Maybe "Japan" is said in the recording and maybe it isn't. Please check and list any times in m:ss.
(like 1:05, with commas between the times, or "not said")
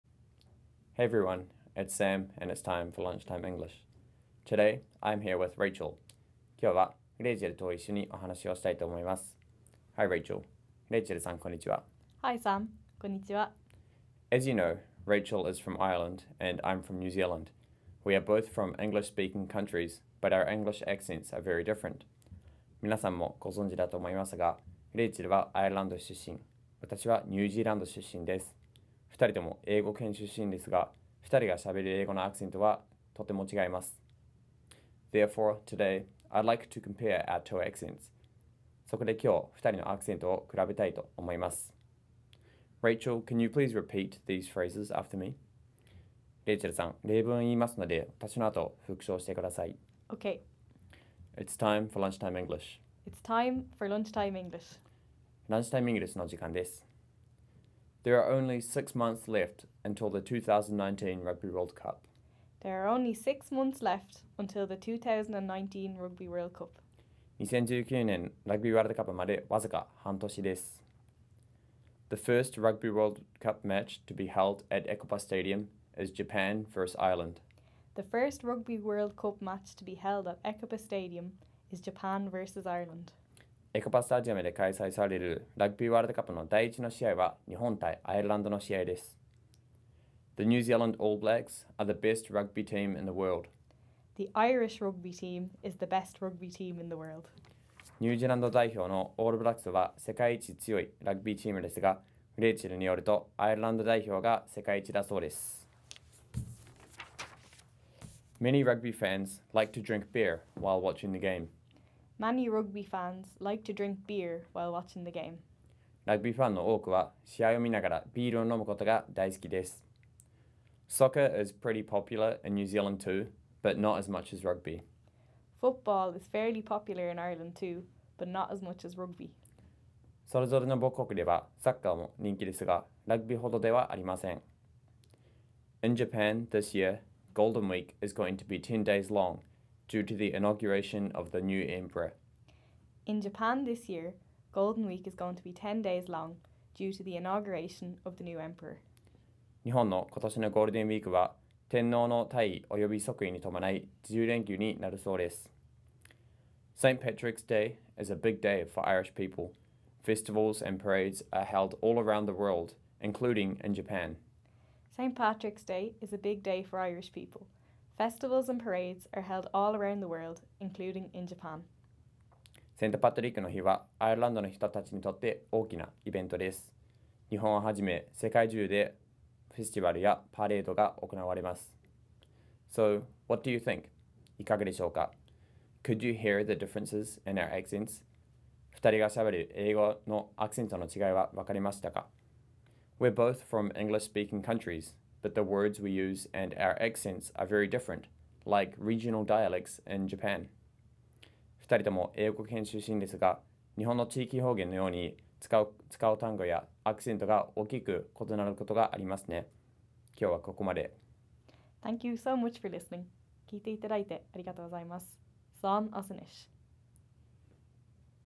1:16, 1:21, 2:15, 2:23, 2:43, 2:51, 3:20.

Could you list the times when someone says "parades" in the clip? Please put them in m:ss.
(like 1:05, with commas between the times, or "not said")
2:40, 2:48.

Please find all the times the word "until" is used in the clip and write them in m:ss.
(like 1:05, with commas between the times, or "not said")
0:59, 1:04.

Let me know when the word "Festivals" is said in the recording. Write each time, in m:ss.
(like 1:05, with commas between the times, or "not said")
2:40, 2:47.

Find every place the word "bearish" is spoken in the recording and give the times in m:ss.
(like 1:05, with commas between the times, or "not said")
not said.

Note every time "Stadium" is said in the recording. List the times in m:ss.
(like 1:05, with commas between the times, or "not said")
1:15, 1:20.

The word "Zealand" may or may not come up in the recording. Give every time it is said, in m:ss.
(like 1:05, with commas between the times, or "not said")
0:17, 1:30, 2:02.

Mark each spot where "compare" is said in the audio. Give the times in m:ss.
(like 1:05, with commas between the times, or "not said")
0:36.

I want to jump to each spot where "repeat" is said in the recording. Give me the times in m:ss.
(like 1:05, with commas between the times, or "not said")
0:43.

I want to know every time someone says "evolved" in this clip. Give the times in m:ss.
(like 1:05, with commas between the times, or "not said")
not said.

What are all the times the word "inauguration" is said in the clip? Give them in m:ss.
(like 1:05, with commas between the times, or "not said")
2:20, 2:27.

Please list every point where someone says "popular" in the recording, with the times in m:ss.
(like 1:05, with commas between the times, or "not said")
2:01, 2:06.